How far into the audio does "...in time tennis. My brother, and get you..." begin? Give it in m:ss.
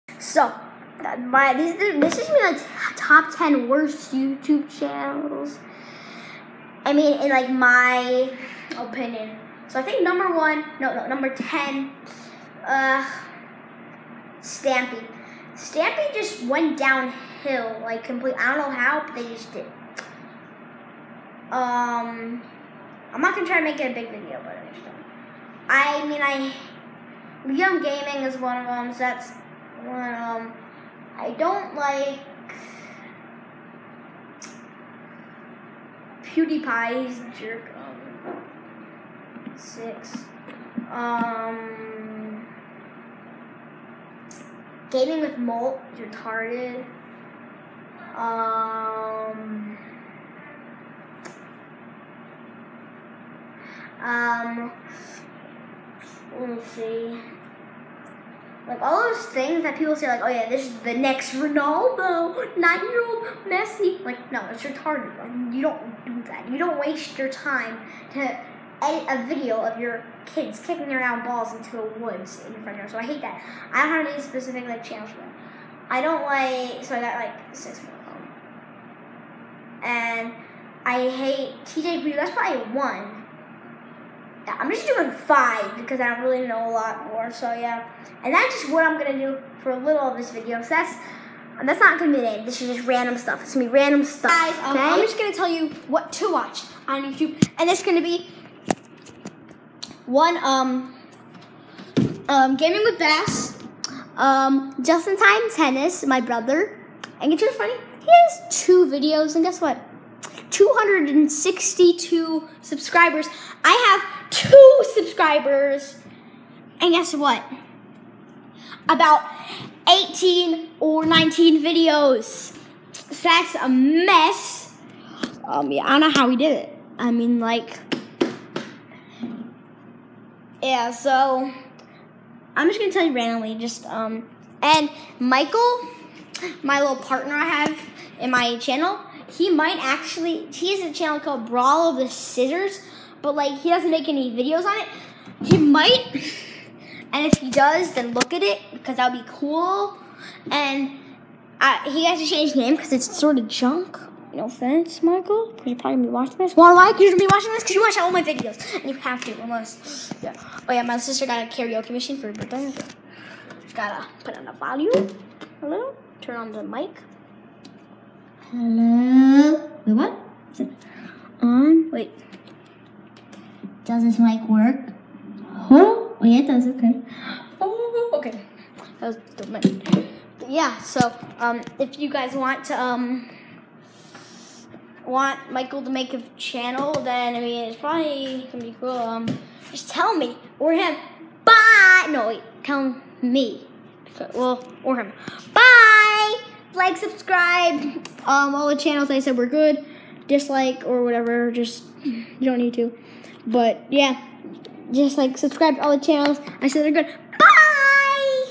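1:45.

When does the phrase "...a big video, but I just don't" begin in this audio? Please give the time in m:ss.
0:23.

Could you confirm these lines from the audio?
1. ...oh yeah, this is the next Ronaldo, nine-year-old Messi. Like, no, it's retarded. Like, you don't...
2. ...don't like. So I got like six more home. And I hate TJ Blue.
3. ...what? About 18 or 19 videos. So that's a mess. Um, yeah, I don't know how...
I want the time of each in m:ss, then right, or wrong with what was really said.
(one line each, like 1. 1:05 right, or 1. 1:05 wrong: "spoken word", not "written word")
1. 1:00 right
2. 1:16 right
3. 1:57 right.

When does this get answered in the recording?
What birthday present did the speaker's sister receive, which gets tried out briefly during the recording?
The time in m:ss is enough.
2:41.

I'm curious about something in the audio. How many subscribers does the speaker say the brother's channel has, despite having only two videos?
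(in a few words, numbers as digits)
262.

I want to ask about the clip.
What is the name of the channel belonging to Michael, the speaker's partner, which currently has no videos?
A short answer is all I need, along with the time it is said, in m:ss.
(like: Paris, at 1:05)
Brawl of the Scissors, at 2:21.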